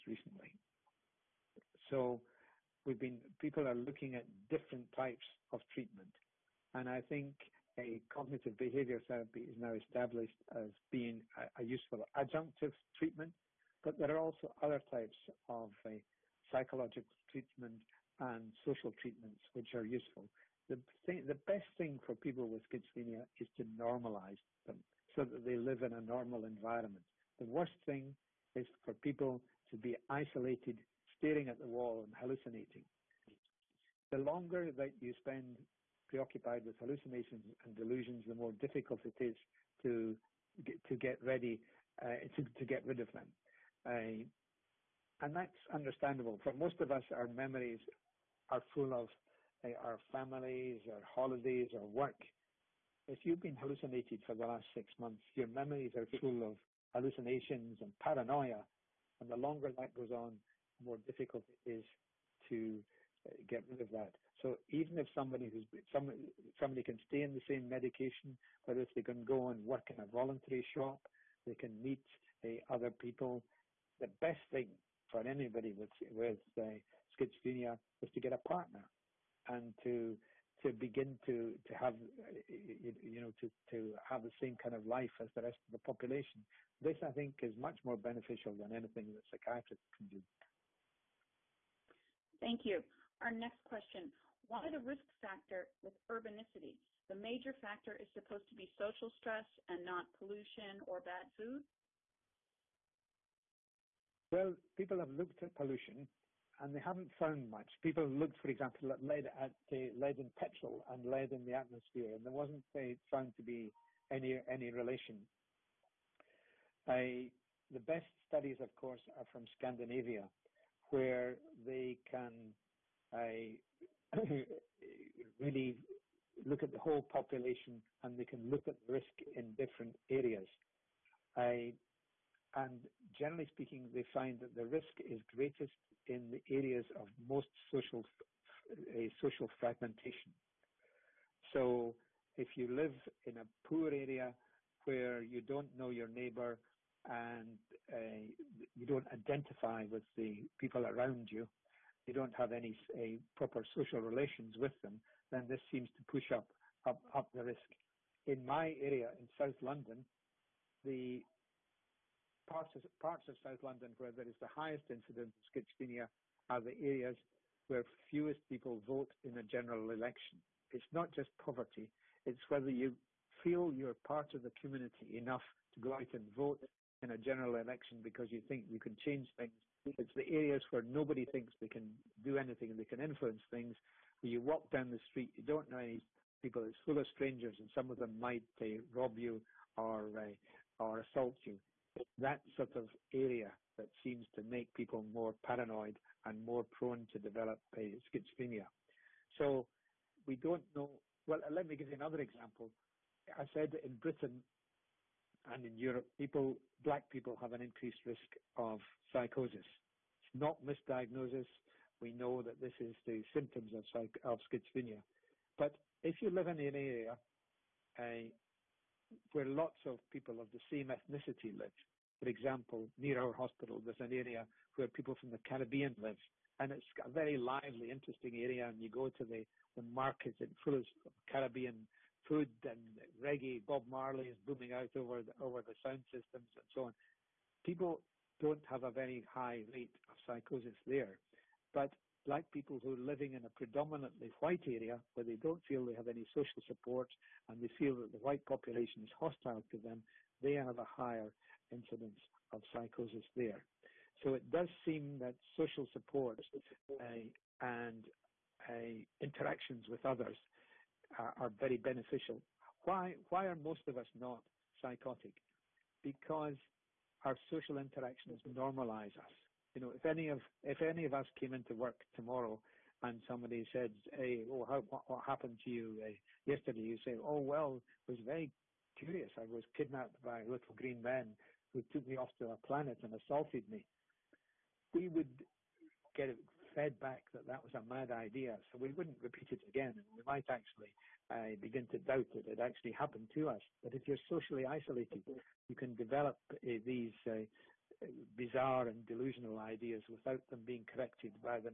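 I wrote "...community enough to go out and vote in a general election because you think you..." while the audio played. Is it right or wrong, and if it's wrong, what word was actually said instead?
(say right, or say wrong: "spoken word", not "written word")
right.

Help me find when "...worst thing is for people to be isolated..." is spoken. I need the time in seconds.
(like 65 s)
27 s.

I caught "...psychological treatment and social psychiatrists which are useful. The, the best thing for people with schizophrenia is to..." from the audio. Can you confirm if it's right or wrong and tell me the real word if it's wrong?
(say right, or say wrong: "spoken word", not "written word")
wrong: "treatments", not "psychiatrists".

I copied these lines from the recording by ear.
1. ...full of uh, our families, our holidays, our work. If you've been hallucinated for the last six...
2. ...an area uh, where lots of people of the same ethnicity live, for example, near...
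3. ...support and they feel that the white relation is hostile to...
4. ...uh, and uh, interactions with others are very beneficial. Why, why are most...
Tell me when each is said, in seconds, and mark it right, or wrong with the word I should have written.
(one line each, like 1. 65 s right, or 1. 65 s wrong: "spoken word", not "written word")
1. 48 s right
2. 216 s right
3. 246 s wrong: "population", not "relation"
4. 256 s right.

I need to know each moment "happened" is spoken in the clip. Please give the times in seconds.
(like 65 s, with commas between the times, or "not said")
275 s, 292 s.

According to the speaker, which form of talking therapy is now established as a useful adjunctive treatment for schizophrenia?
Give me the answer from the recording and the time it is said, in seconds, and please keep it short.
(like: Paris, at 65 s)
Cognitive behavior therapy, at 8 s.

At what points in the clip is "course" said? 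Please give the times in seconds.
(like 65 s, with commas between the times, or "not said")
118 s.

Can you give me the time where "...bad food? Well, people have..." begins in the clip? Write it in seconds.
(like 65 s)
100 s.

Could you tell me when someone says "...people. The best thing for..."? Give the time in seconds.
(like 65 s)
72 s.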